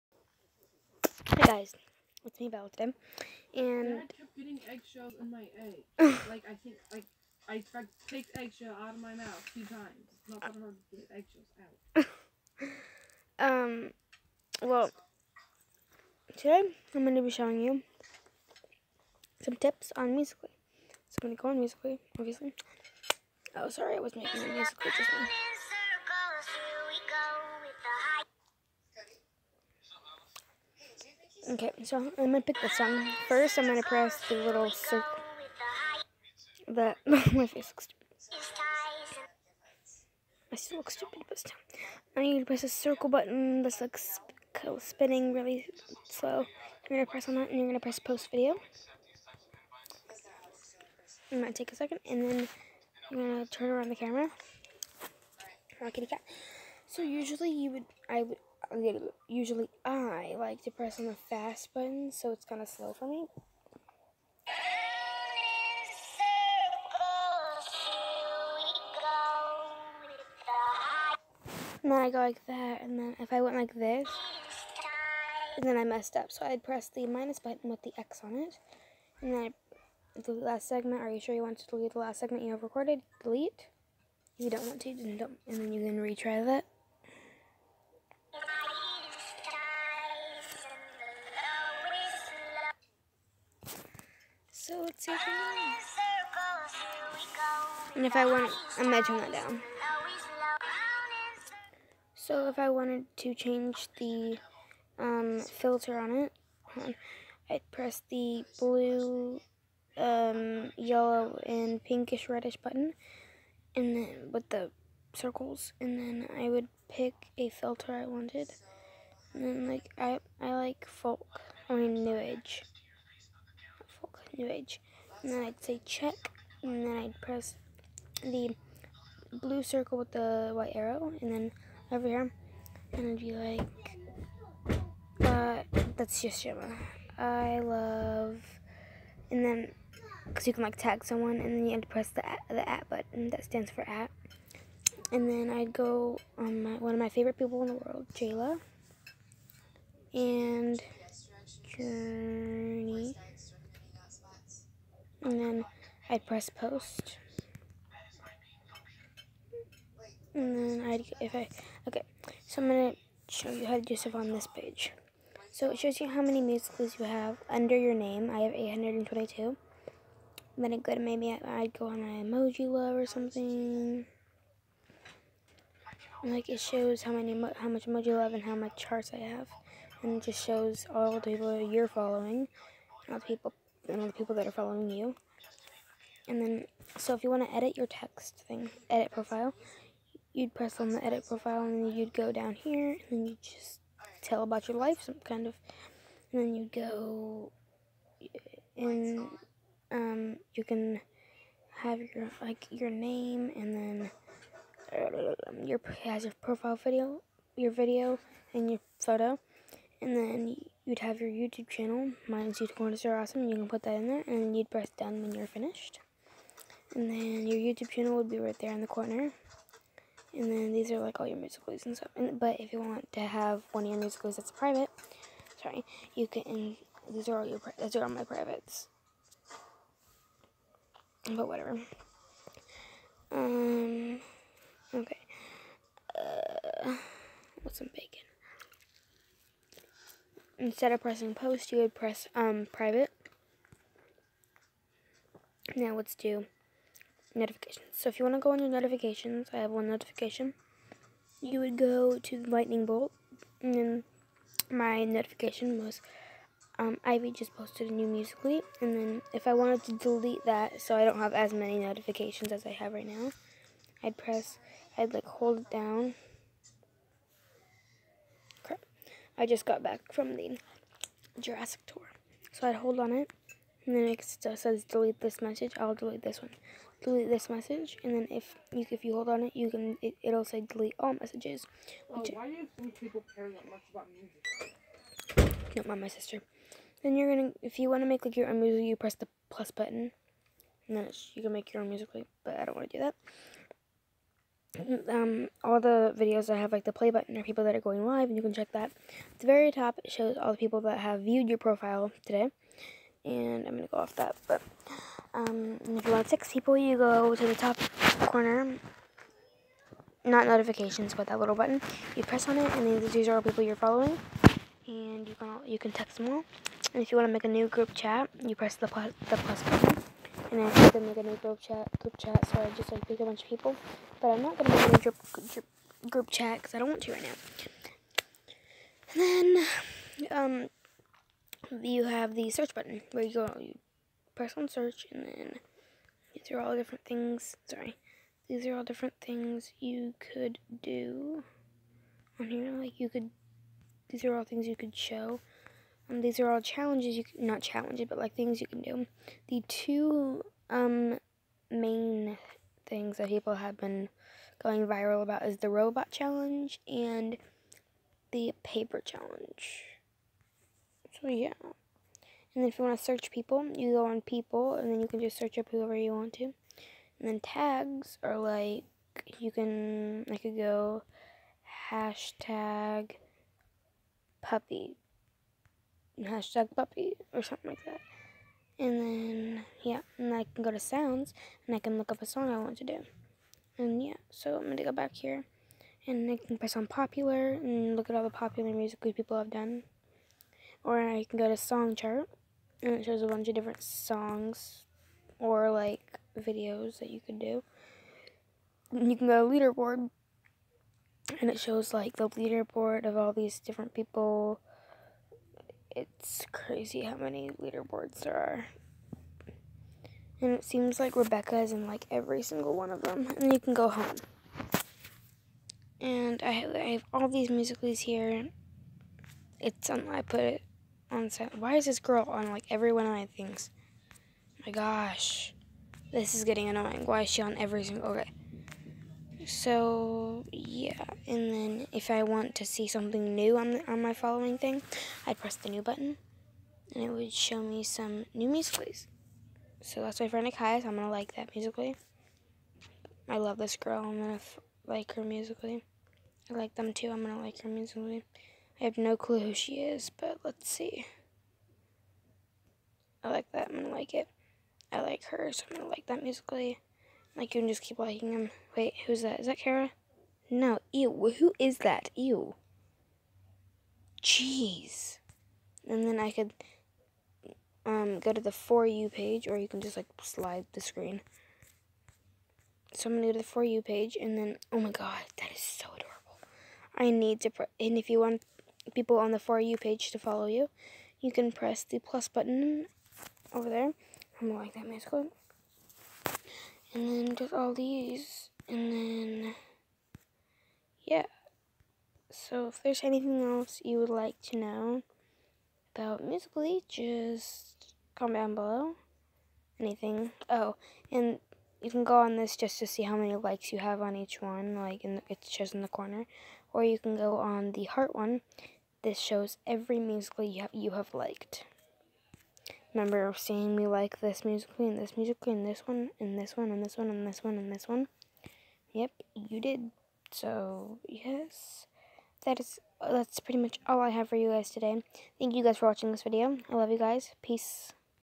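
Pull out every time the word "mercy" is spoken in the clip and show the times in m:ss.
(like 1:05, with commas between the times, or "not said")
not said.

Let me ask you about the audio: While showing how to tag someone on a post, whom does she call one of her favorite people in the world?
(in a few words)
Jayla.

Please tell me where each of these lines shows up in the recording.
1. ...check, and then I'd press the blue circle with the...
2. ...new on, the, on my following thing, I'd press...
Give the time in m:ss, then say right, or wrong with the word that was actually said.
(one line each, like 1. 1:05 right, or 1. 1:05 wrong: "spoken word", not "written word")
1. 2:05 right
2. 7:13 right.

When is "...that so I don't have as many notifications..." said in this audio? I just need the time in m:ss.
4:20.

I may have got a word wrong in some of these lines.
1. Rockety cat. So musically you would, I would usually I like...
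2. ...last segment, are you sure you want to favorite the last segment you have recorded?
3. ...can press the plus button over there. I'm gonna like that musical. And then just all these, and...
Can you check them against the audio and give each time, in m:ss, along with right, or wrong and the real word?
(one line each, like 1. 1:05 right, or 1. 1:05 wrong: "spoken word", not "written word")
1. 0:55 wrong: "usually", not "musically"
2. 1:20 wrong: "delete", not "favorite"
3. 8:01 right.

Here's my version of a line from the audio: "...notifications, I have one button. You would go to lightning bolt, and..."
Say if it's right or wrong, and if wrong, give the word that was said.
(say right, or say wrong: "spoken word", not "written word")
wrong: "notification", not "button".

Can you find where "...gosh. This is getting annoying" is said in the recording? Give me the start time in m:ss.
7:04.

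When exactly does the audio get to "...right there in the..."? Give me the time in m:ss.
3:38.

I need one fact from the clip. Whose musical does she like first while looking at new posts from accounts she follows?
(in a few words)
Akaya.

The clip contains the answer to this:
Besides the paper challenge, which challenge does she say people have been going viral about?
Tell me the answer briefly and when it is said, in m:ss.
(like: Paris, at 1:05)
Robot challenge, at 5:55.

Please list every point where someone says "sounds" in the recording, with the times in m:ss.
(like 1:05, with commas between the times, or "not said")
6:20.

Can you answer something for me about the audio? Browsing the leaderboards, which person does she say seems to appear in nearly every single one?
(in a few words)
Rebecca.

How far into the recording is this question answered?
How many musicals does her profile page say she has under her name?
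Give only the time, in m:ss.
2:48.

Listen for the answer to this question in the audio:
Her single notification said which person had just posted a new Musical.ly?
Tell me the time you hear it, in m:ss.
4:17.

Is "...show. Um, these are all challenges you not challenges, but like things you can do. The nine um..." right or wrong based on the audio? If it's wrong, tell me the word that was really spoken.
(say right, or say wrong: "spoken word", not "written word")
wrong: "two", not "nine".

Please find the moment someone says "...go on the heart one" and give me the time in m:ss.
8:27.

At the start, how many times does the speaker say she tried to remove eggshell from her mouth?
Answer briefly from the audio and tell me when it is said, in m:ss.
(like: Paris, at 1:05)
2, at 0:09.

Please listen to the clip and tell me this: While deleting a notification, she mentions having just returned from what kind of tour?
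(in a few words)
Jurassic tour.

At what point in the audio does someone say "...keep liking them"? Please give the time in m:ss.
7:37.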